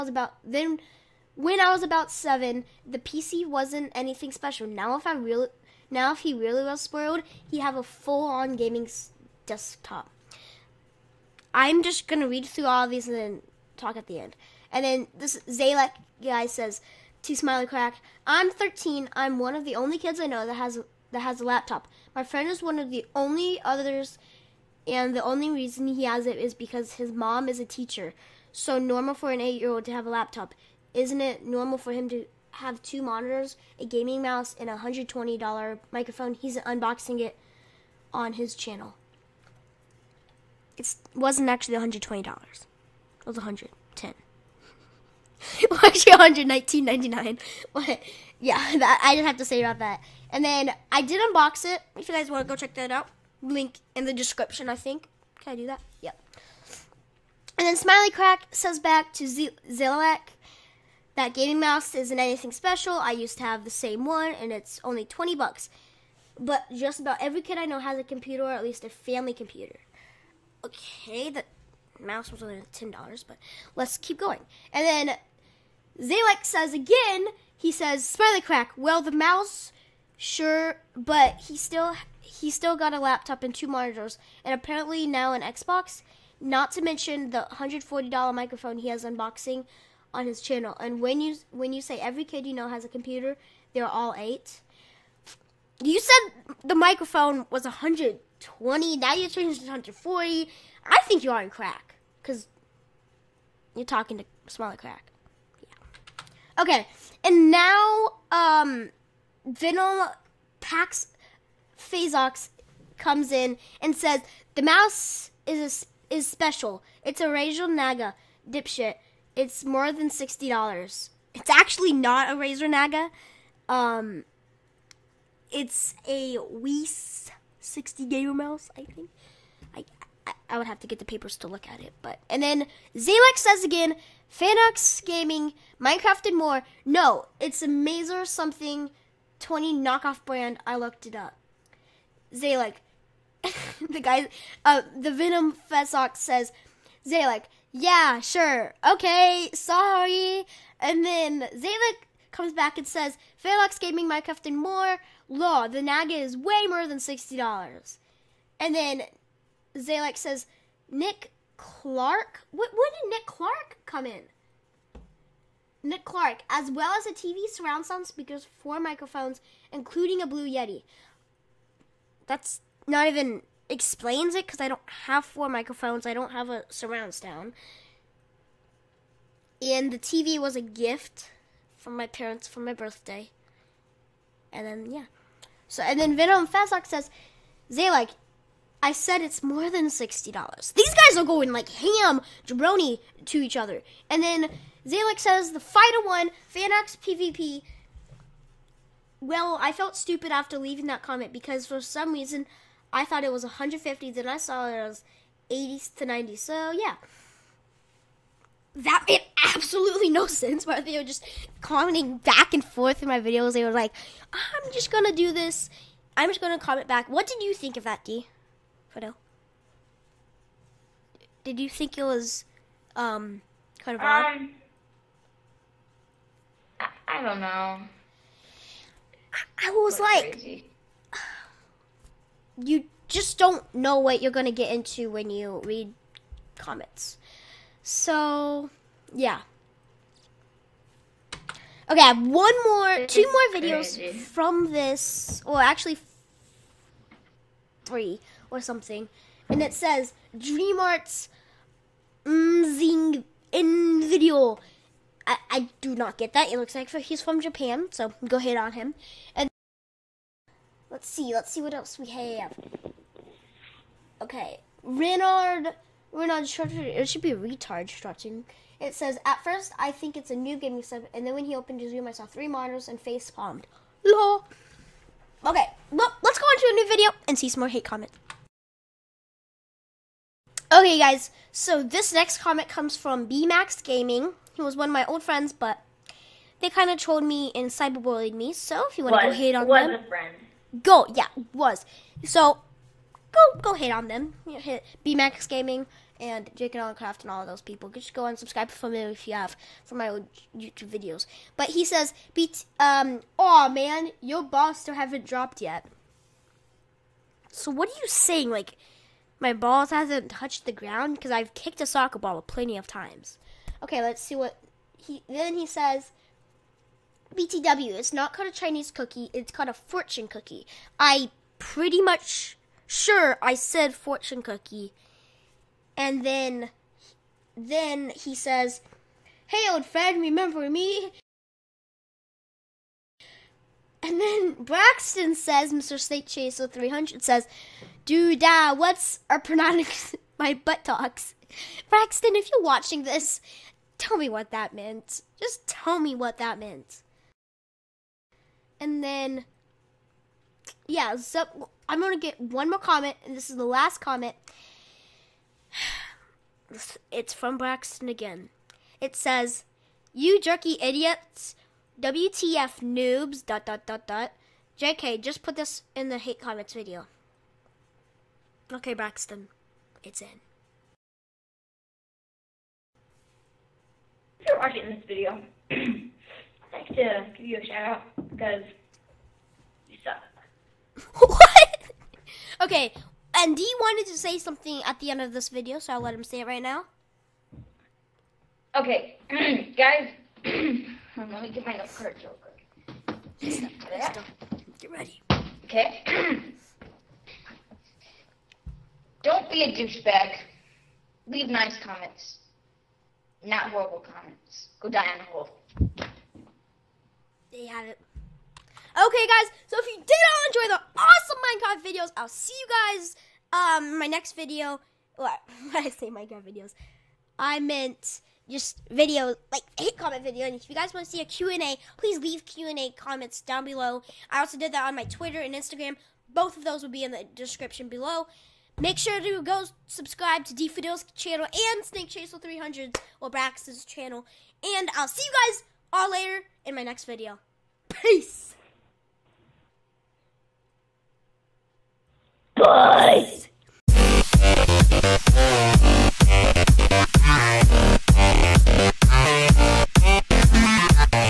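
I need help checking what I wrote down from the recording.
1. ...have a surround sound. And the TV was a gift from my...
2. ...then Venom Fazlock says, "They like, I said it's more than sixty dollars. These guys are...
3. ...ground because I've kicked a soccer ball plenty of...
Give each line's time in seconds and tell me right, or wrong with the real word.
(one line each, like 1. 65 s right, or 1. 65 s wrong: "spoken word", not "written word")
1. 176 s right
2. 186 s right
3. 310 s right.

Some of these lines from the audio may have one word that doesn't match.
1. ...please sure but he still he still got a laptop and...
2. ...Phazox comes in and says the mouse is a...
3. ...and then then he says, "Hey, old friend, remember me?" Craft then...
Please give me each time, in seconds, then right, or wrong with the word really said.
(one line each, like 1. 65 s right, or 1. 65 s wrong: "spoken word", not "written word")
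1. 79 s wrong: "mouse", not "please"
2. 111 s right
3. 325 s wrong: "And", not "Craft".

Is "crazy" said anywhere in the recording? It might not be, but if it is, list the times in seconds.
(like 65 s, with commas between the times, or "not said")
230 s, 243 s.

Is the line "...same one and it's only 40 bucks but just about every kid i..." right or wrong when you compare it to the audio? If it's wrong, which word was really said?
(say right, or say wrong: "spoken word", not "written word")
wrong: "20", not "40".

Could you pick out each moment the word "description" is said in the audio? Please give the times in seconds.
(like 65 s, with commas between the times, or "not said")
54 s, 427 s.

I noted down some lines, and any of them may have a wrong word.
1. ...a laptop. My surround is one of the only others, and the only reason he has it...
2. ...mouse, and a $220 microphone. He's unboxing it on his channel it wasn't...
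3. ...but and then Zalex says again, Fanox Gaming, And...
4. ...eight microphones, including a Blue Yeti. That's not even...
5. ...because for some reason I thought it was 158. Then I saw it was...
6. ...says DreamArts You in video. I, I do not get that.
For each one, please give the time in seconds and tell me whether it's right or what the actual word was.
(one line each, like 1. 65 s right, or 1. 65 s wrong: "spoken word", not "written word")
1. 21 s wrong: "friend", not "surround"
2. 34 s wrong: "120", not "220"
3. 132 s wrong: "Minecraft", not "And"
4. 168 s wrong: "four", not "eight"
5. 201 s wrong: "150", not "158"
6. 249 s wrong: "Mzing", not "You".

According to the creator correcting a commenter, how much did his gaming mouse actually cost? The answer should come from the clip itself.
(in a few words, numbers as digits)
$10.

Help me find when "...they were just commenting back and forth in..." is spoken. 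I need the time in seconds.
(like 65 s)
210 s.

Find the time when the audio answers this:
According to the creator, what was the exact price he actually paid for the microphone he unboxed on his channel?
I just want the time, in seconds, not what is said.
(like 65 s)
46 s.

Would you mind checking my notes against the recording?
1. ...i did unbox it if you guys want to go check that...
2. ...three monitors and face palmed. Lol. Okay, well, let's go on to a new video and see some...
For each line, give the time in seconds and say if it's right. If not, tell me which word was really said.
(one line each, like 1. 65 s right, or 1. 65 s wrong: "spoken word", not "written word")
1. 50 s right
2. 272 s right.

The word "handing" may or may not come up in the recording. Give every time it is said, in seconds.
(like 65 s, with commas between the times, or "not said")
not said.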